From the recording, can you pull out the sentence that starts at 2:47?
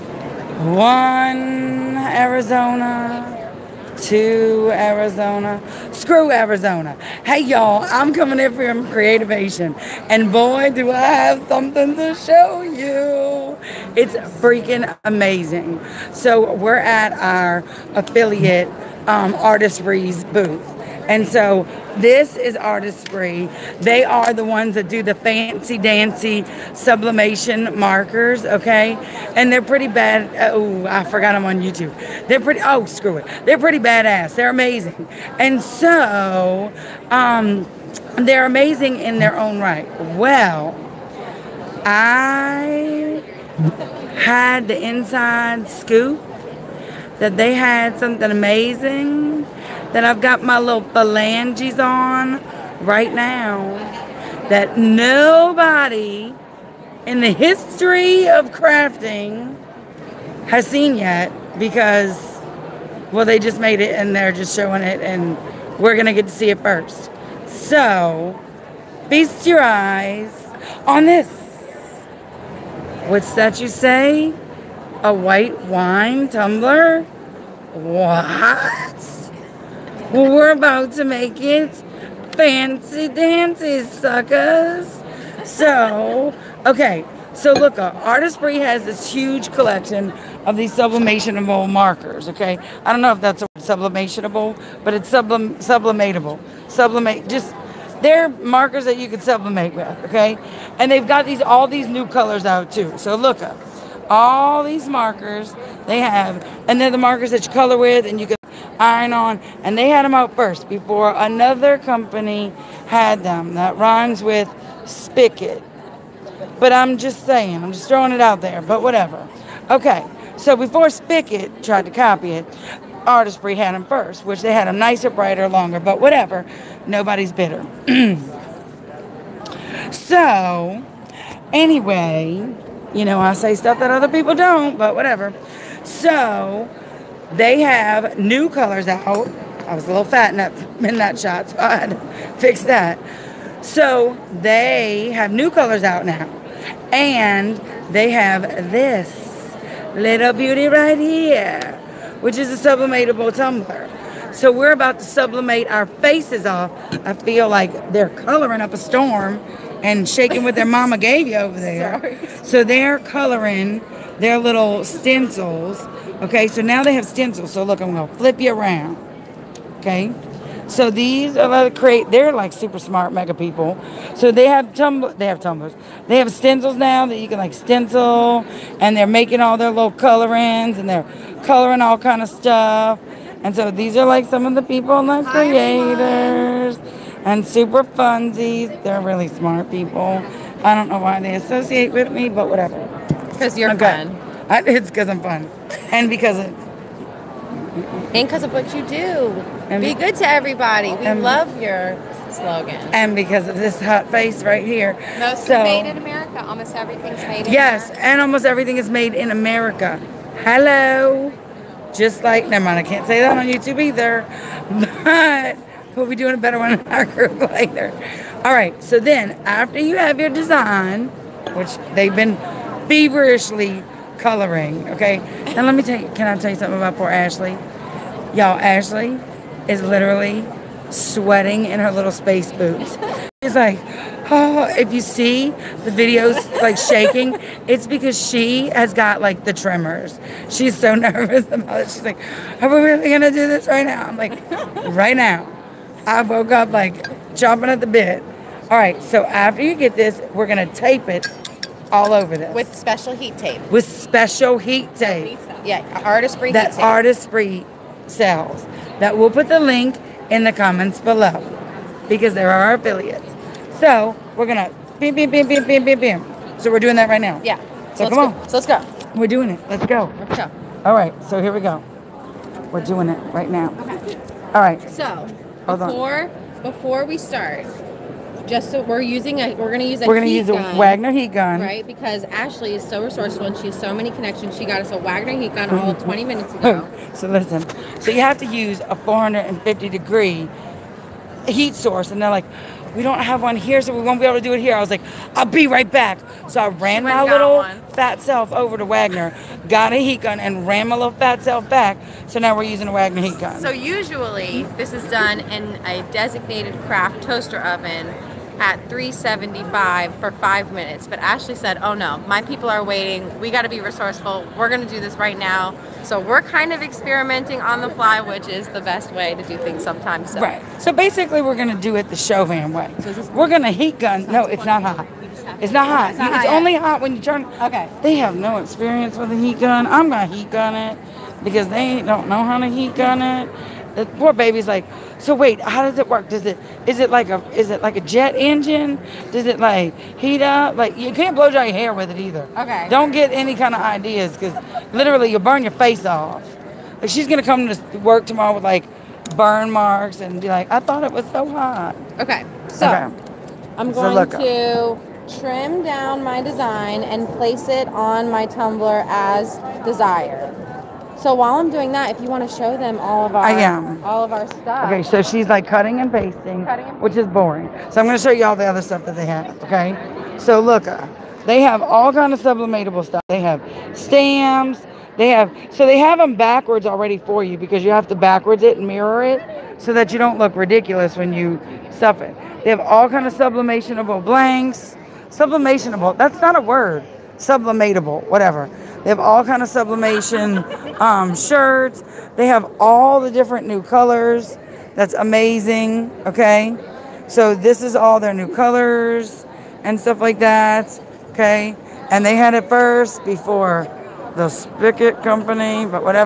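So look, I'm gonna flip you around.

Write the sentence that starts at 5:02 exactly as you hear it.
So now we're using a Wagner heat gun.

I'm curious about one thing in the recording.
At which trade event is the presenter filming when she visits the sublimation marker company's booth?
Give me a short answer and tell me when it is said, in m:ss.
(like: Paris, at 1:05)
Creativation, at 0:08.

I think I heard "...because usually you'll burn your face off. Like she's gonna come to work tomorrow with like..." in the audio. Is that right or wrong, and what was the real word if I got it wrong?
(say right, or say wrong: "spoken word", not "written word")
wrong: "literally", not "usually".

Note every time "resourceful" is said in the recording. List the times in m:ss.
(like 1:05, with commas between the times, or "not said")
4:43, 5:13.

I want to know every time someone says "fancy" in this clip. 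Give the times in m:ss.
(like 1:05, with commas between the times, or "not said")
0:25, 1:22.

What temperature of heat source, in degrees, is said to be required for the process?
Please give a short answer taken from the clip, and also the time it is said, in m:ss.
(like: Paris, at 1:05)
450, at 4:48.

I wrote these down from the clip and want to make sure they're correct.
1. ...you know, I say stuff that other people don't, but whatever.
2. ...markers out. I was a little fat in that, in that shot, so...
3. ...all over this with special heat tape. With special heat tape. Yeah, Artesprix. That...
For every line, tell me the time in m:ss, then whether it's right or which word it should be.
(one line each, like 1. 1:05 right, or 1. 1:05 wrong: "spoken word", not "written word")
1. 2:12 right
2. 2:18 wrong: "colors", not "markers"
3. 4:11 right.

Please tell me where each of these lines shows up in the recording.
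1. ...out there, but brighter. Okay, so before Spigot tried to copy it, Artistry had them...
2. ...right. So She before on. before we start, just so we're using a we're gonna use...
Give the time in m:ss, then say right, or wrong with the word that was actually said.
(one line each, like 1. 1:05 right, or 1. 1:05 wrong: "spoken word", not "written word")
1. 1:58 wrong: "whatever", not "brighter"
2. 4:34 wrong: "Hold", not "She".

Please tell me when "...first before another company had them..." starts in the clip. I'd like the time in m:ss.
1:50.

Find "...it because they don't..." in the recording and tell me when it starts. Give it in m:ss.
5:30.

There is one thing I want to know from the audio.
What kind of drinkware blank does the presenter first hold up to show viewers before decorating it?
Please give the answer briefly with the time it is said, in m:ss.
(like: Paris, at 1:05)
white wine tumbler, at 1:15.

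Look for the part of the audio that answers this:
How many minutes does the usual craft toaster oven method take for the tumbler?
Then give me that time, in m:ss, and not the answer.
5:10.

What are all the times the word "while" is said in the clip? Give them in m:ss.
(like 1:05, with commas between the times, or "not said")
6:01.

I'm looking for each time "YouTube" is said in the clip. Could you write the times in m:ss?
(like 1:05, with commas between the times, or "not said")
0:31, 3:33.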